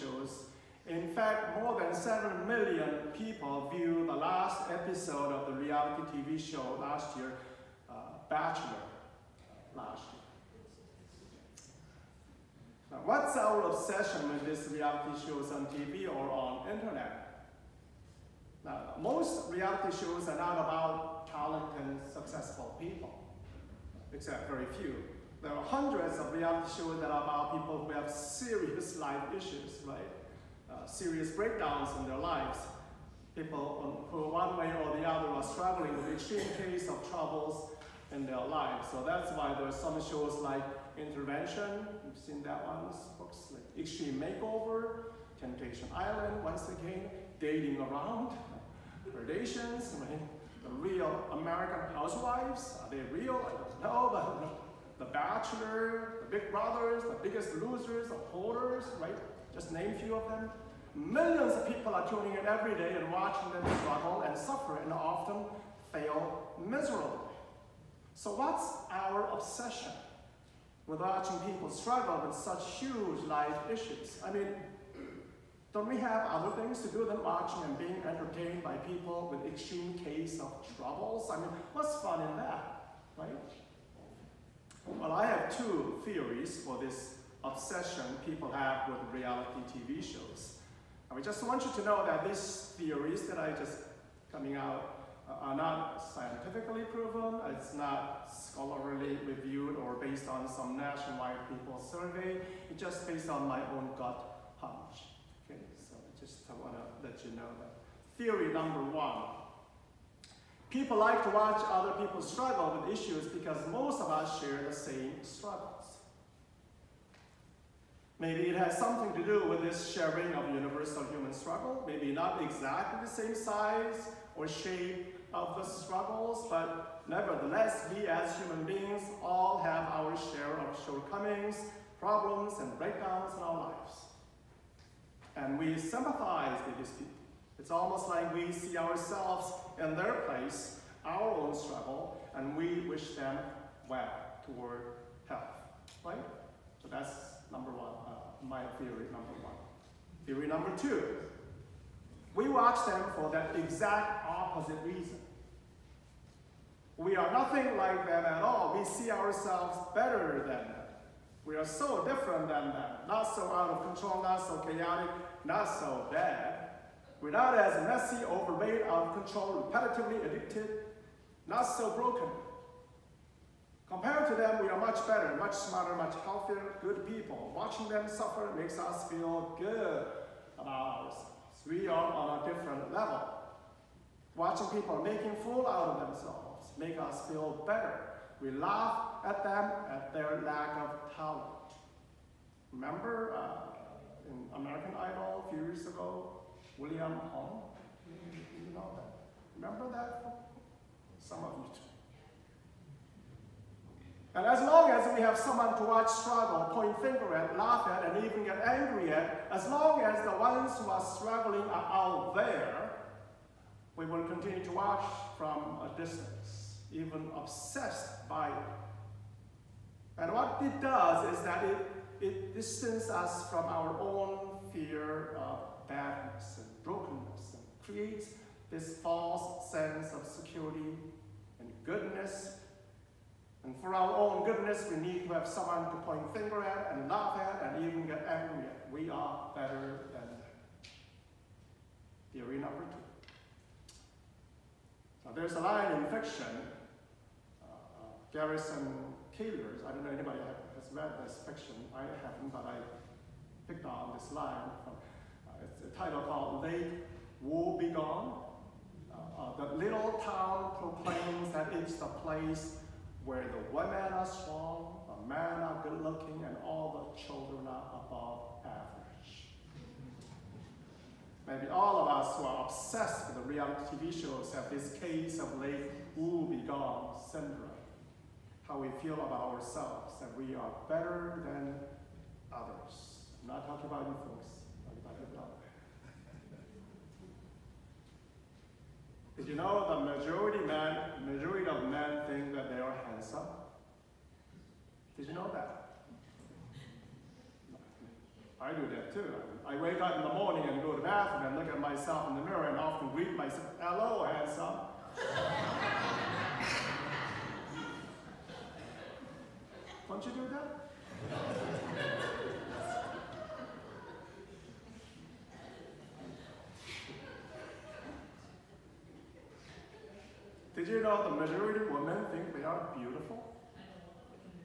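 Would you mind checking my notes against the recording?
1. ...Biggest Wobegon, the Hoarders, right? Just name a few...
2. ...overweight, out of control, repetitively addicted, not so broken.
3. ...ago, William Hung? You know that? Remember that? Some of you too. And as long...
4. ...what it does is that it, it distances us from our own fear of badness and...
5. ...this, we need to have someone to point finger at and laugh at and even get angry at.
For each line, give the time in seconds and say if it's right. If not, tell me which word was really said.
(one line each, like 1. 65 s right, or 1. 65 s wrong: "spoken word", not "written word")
1. 57 s wrong: "Losers", not "Wobegon"
2. 168 s right
3. 195 s right
4. 220 s right
5. 234 s right.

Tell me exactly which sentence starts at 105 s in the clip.
Okay, so I just want to let you know that.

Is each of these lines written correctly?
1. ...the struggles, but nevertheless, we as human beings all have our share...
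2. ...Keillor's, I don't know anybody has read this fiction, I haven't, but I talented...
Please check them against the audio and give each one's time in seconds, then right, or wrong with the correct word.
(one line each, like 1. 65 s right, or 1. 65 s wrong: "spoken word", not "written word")
1. 125 s right
2. 249 s wrong: "picked", not "talented".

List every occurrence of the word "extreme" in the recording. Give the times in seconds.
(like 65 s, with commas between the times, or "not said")
36 s, 43 s, 79 s.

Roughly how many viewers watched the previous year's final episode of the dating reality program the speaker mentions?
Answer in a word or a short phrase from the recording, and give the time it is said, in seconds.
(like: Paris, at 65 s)
7 million, at 1 s.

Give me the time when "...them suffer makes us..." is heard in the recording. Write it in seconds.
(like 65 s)
177 s.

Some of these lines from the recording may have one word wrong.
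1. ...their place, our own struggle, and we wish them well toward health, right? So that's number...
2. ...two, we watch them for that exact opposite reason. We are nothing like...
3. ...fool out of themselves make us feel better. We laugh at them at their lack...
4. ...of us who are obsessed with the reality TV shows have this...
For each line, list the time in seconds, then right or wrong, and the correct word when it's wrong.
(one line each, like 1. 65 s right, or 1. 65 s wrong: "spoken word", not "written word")
1. 139 s right
2. 150 s right
3. 185 s right
4. 272 s right.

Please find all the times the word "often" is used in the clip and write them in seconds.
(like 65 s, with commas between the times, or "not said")
64 s, 302 s.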